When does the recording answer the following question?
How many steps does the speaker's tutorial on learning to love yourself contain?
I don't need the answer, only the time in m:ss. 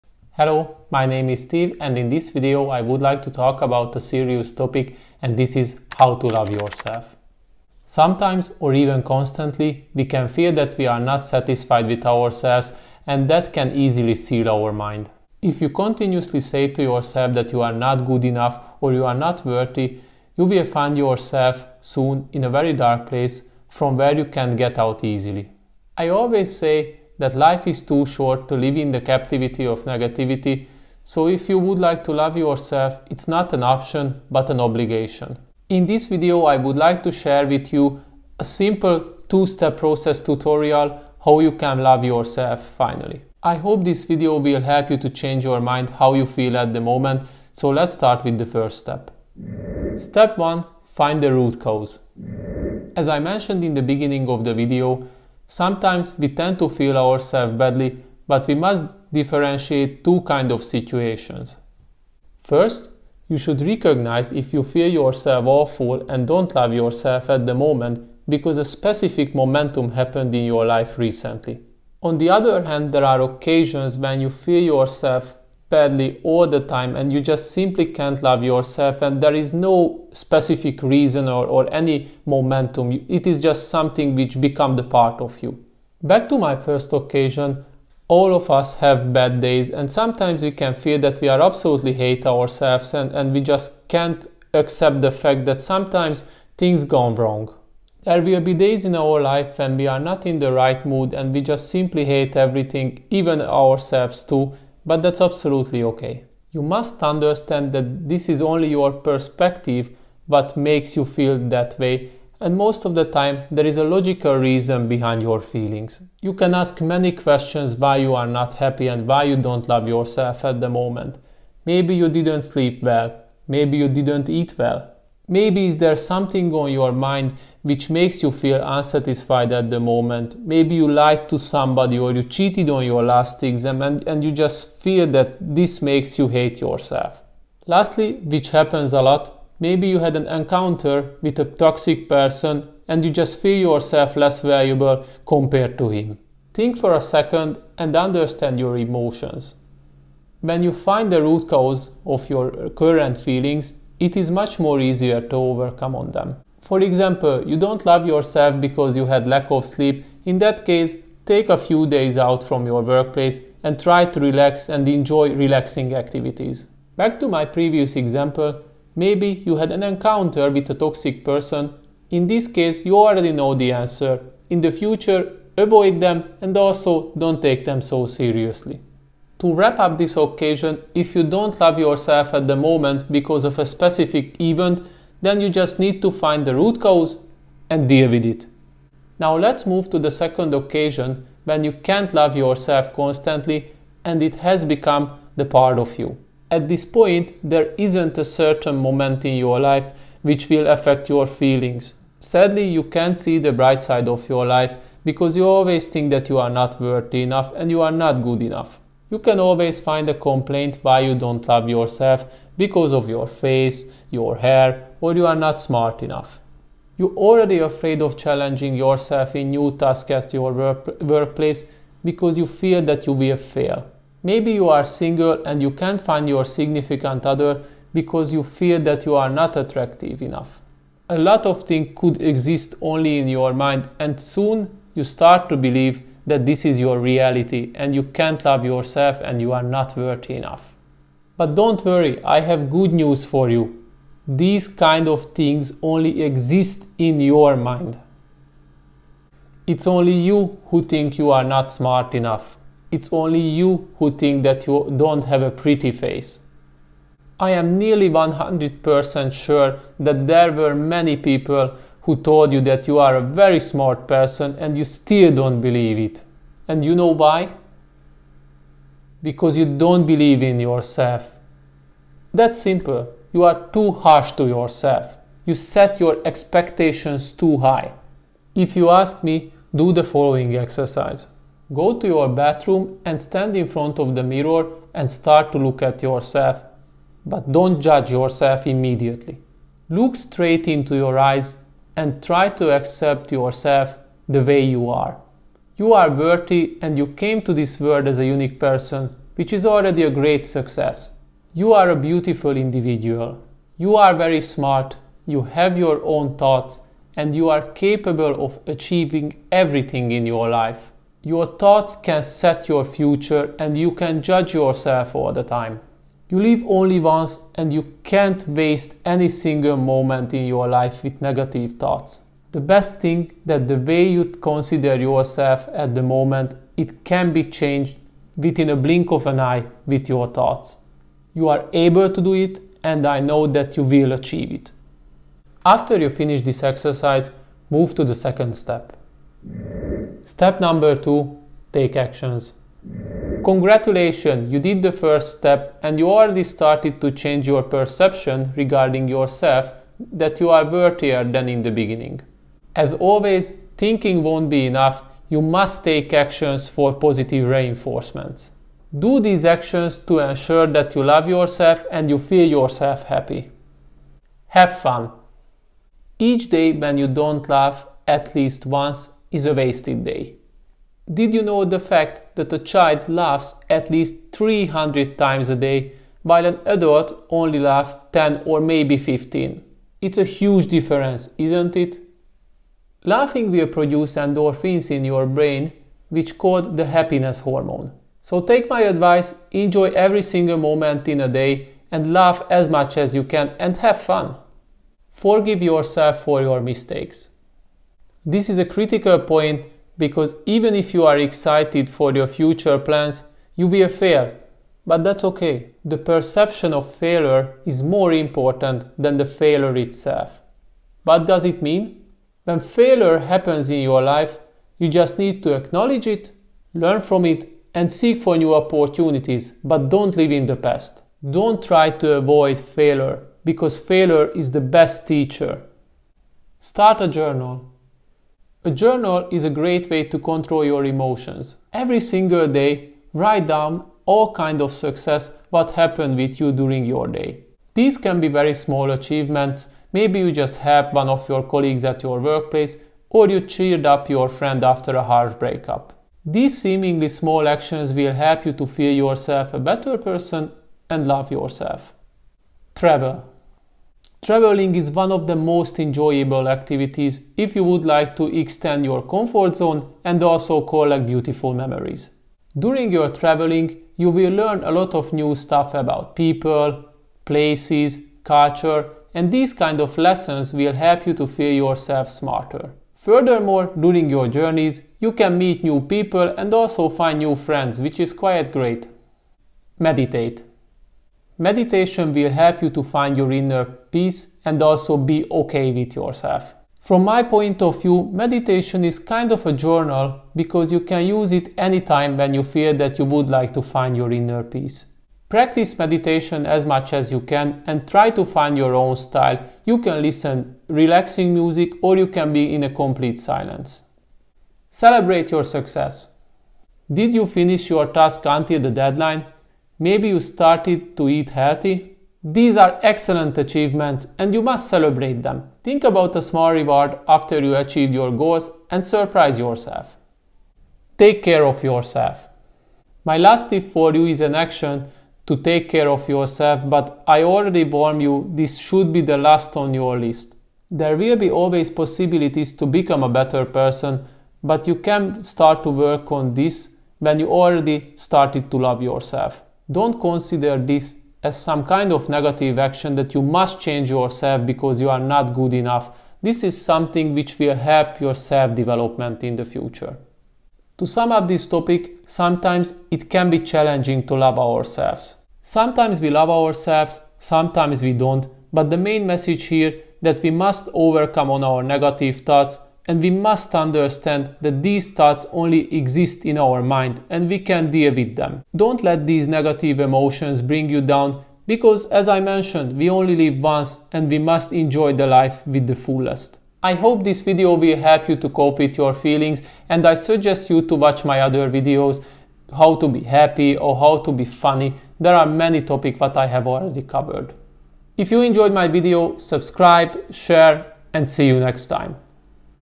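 0:39.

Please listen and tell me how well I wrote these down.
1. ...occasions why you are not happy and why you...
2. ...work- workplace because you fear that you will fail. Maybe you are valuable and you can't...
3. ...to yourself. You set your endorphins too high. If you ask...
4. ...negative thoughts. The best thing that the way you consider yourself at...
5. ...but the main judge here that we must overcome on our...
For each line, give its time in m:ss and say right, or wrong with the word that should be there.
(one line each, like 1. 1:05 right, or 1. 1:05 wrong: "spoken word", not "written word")
1. 1:57 wrong: "questions", not "occasions"
2. 3:40 wrong: "single", not "valuable"
3. 4:34 wrong: "expectations", not "endorphins"
4. 5:21 right
5. 9:18 wrong: "message", not "judge".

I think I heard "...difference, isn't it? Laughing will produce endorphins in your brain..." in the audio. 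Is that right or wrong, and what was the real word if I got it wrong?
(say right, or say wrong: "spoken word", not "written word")
right.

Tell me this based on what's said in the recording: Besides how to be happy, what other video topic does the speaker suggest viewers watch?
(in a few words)
How to be funny.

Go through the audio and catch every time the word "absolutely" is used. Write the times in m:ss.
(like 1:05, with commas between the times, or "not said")
1:31, 1:45.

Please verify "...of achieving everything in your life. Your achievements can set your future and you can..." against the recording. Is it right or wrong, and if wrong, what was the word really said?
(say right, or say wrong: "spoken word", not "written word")
wrong: "thoughts", not "achievements".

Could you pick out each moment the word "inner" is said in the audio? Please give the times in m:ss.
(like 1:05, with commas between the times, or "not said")
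8:03, 8:14.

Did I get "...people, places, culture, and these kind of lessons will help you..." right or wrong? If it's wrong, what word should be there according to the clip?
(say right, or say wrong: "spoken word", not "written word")
right.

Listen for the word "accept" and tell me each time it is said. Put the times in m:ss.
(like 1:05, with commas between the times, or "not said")
1:34, 4:52.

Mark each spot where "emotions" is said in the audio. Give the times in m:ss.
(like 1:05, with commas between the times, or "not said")
2:28, 7:10, 9:29.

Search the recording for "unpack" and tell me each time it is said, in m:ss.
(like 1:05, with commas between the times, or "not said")
not said.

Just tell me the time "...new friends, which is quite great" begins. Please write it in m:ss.
7:57.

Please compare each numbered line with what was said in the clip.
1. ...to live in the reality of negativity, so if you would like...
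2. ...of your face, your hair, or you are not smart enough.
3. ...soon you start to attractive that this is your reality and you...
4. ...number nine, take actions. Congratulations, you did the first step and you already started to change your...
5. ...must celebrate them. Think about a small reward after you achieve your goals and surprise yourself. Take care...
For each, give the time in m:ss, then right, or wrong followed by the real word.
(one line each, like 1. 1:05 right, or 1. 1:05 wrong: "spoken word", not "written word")
1. 0:28 wrong: "captivity", not "reality"
2. 3:32 right
3. 3:54 wrong: "believe", not "attractive"
4. 5:40 wrong: "two", not "nine"
5. 8:34 right.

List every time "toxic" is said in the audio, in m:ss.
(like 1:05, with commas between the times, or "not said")
2:21, 2:50.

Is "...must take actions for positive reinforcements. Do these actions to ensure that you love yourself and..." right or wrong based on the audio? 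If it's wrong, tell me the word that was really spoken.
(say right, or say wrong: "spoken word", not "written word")
right.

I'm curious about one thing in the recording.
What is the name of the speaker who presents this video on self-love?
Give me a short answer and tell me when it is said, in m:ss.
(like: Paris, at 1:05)
Steve, at 0:01.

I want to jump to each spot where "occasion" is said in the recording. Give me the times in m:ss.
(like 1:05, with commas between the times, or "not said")
1:13, 1:26, 3:00, 3:10.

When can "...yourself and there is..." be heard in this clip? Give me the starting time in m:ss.
1:18.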